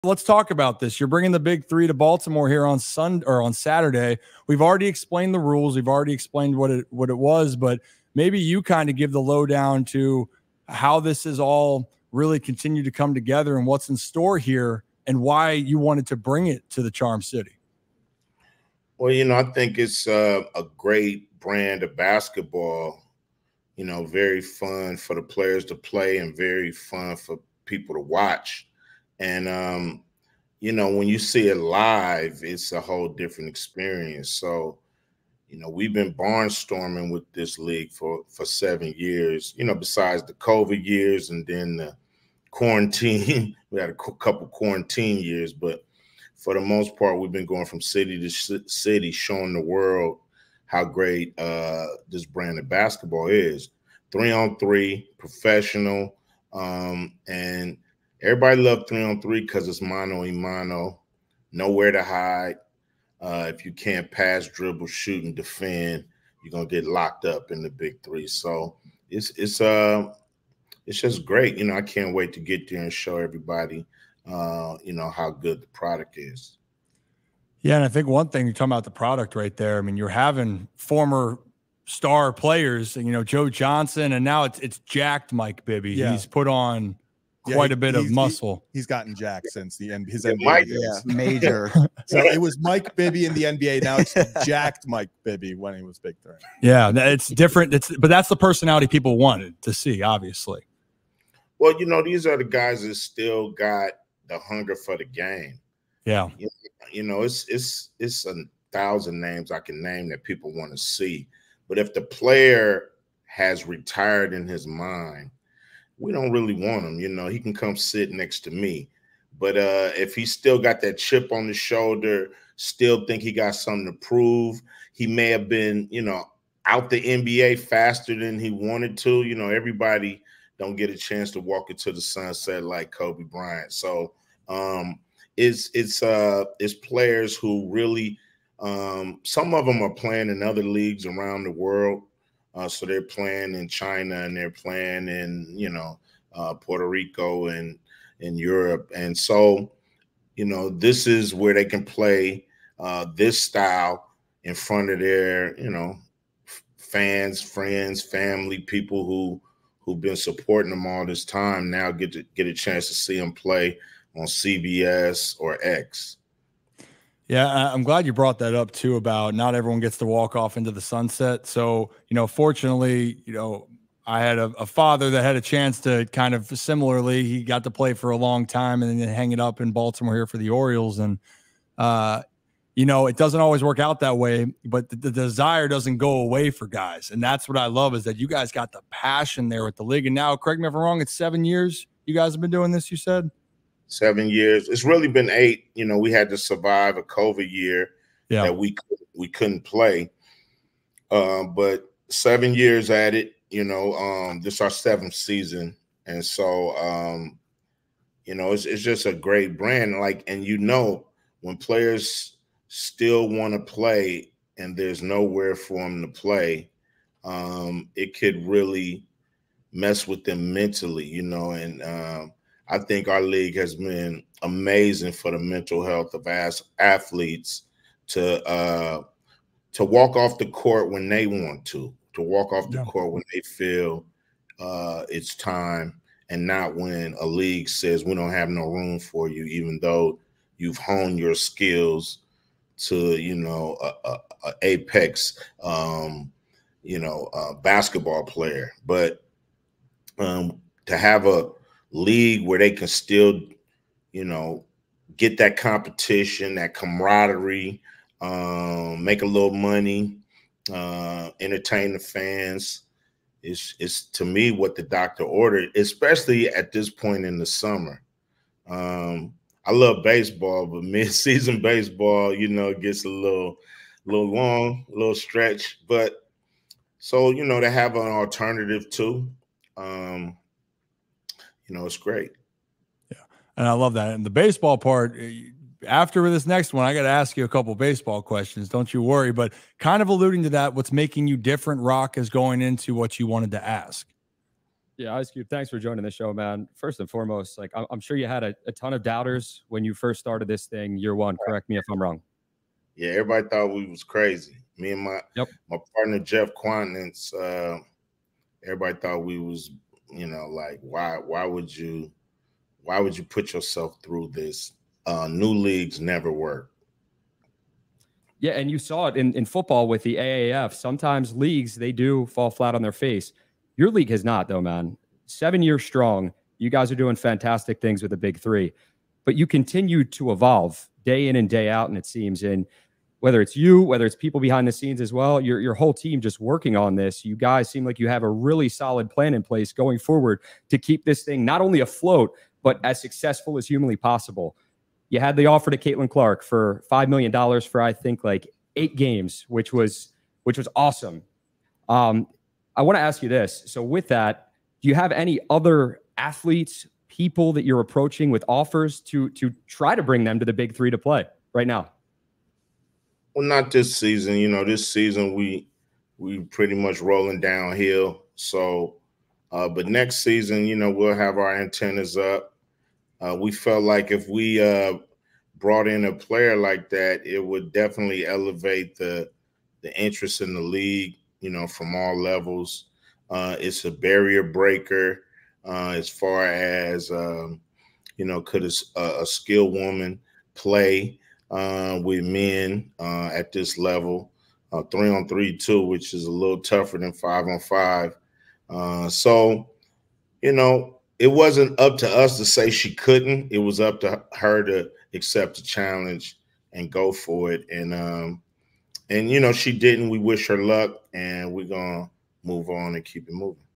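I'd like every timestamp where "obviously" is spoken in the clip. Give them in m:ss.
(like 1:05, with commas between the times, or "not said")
1:40.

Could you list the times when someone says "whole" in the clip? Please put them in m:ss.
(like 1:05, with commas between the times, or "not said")
0:32, 5:35.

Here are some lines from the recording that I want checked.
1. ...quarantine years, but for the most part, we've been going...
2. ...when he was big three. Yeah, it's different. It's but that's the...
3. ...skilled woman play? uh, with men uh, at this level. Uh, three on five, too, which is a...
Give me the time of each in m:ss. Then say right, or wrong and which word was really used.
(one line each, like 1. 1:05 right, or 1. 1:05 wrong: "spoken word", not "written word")
1. 0:44 right
2. 1:35 right
3. 6:29 wrong: "three", not "five".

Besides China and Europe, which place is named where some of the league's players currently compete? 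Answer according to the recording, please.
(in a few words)
Puerto Rico.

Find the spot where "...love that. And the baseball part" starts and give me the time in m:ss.
4:43.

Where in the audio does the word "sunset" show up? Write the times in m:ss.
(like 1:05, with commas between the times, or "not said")
2:12, 2:50.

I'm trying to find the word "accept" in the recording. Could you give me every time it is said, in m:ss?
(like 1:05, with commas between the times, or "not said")
6:45.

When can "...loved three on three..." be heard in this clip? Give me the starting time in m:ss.
0:58.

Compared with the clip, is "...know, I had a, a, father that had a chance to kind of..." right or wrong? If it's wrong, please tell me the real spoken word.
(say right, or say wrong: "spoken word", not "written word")
right.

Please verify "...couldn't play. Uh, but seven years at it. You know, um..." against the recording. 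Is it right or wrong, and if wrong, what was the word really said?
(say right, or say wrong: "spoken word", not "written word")
right.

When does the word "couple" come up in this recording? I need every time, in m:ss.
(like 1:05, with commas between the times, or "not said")
0:43, 4:47.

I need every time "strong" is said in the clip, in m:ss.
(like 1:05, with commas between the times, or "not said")
5:25.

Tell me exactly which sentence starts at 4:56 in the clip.
First and foremost, like I'm, sure you had a, a, ton of doubters when you first started this thing year one.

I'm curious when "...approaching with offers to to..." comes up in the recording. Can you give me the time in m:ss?
5:57.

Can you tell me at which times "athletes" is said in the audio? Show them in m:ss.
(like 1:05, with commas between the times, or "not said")
3:46, 5:56.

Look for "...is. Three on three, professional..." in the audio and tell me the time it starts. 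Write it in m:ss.
0:53.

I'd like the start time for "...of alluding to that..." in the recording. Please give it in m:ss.
4:50.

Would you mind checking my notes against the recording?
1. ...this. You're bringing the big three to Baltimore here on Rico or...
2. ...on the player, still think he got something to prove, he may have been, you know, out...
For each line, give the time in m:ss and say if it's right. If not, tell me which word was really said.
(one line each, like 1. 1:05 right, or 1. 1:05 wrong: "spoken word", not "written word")
1. 0:00 wrong: "Sunday", not "Rico"
2. 2:01 wrong: "shoulder", not "player".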